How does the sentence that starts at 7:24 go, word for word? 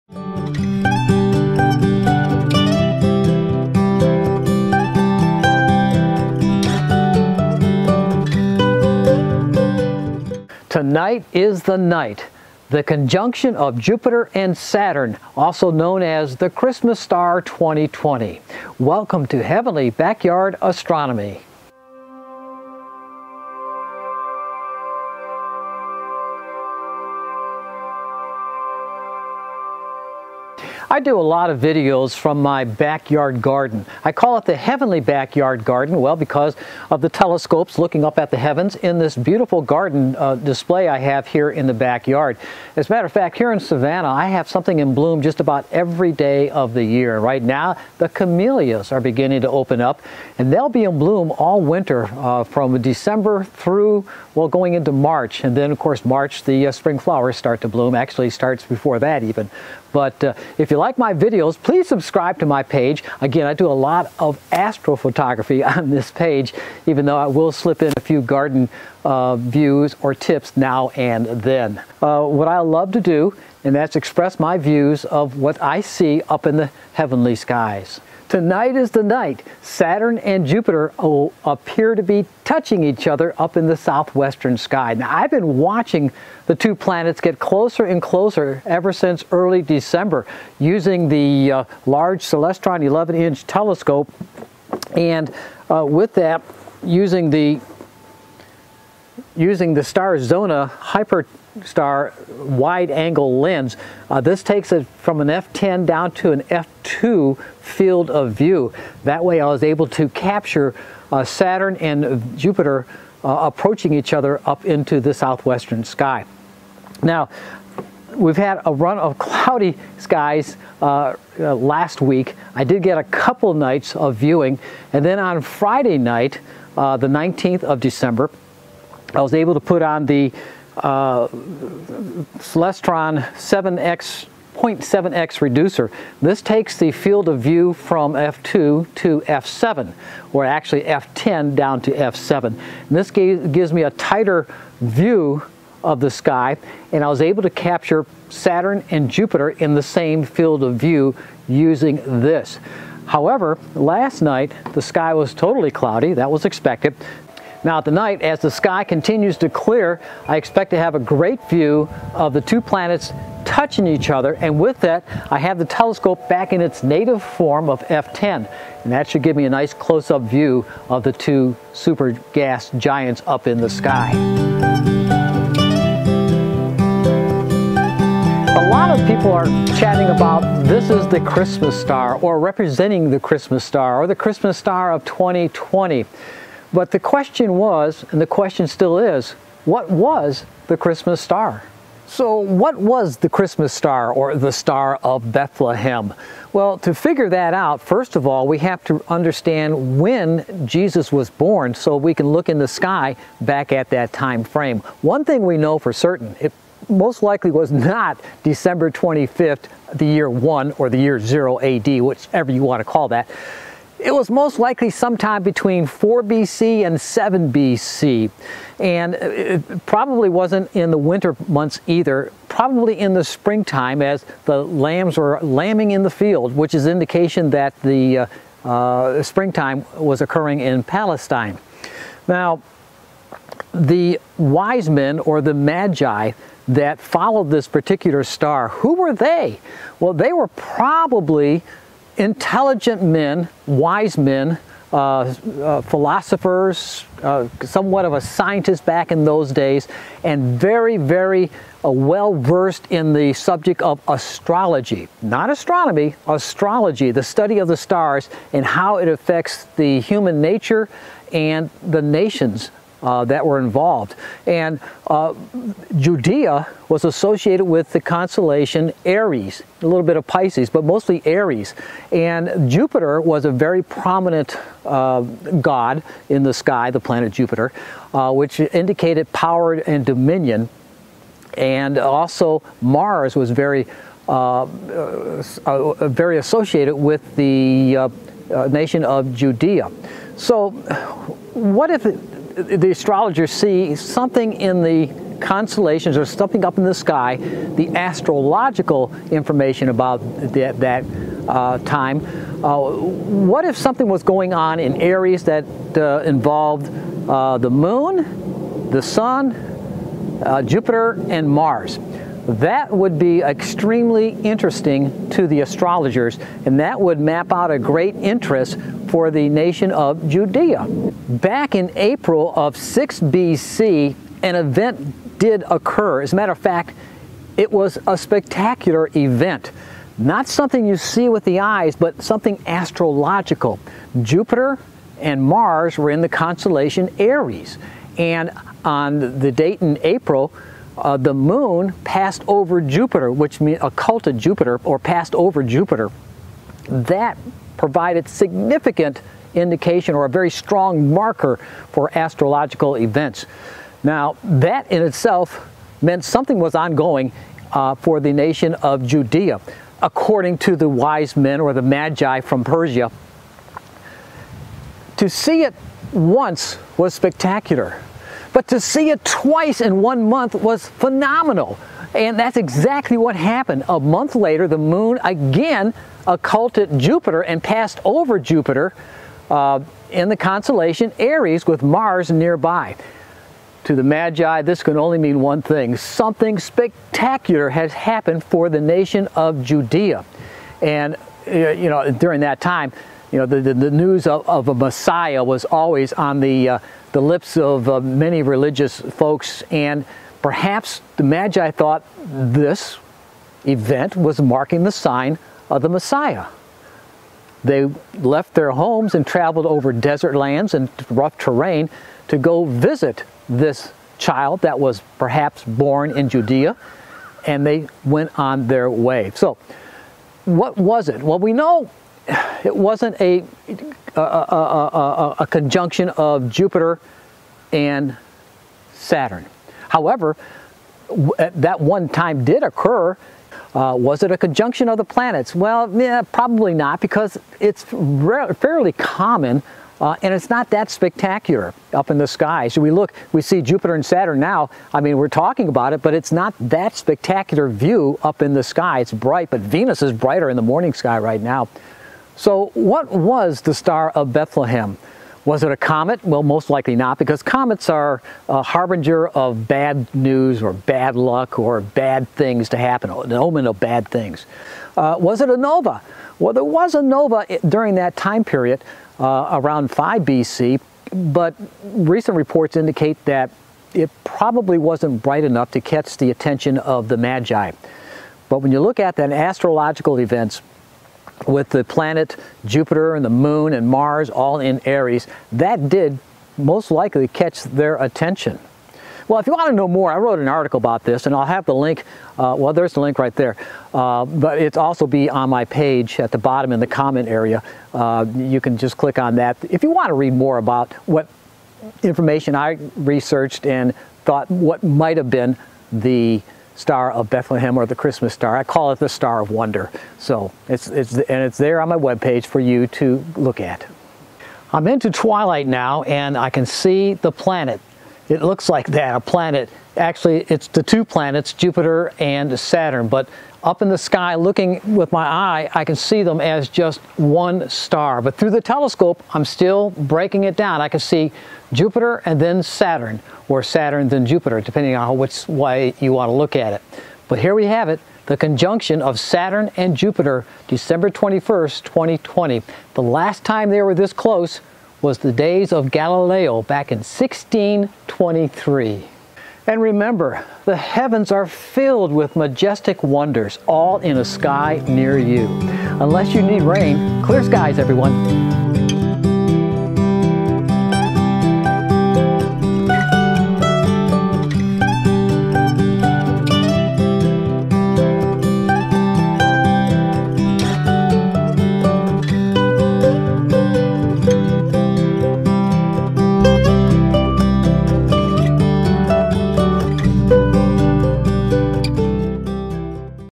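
I mean, we're talking about it, but it's not that spectacular view up in the sky.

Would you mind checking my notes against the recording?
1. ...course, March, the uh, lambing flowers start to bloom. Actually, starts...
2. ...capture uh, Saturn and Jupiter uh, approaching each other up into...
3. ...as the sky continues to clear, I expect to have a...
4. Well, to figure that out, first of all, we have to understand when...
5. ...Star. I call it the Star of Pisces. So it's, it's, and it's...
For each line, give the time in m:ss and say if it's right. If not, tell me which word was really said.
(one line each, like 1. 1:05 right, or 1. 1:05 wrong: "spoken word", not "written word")
1. 0:55 wrong: "spring", not "lambing"
2. 1:50 right
3. 2:38 right
4. 3:16 right
5. 8:28 wrong: "Wonder", not "Pisces".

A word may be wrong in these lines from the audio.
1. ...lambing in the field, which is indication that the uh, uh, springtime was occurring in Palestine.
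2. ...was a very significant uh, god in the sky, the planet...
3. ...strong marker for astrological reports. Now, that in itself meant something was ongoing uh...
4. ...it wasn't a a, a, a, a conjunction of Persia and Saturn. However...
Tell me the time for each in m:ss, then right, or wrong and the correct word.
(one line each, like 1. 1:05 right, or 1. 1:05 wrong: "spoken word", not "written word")
1. 3:45 right
2. 4:33 wrong: "prominent", not "significant"
3. 5:50 wrong: "events", not "reports"
4. 7:02 wrong: "Jupiter", not "Persia".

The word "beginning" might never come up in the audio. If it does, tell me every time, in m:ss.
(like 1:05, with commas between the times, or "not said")
0:48.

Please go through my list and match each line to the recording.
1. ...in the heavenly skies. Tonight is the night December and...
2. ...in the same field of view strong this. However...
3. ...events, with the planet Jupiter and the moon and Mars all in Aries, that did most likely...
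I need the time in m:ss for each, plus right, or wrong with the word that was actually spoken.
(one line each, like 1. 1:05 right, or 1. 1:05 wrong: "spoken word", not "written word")
1. 1:16 wrong: "Saturn", not "December"
2. 2:29 wrong: "using", not "strong"
3. 8:00 right.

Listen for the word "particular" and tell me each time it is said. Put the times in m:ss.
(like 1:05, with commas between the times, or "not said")
3:57.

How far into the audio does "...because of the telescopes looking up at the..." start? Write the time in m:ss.
0:36.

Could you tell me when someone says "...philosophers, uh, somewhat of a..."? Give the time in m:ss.
4:05.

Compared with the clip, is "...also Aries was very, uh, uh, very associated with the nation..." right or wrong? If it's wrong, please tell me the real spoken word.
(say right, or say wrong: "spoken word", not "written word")
wrong: "Mars", not "Aries".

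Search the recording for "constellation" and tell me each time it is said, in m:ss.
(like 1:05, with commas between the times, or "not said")
4:28, 4:55, 5:36, 6:20.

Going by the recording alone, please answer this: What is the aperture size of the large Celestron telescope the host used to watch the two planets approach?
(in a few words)
11 inch.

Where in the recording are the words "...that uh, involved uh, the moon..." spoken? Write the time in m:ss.
5:05.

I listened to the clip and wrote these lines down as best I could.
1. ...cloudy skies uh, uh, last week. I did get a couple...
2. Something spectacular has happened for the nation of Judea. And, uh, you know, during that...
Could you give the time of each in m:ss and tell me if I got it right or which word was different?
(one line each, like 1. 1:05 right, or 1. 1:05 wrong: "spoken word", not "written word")
1. 1:59 right
2. 6:25 right.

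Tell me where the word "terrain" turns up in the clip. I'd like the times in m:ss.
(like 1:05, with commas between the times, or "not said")
6:51.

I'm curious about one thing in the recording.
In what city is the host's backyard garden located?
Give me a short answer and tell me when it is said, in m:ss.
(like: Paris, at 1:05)
Savannah, at 0:43.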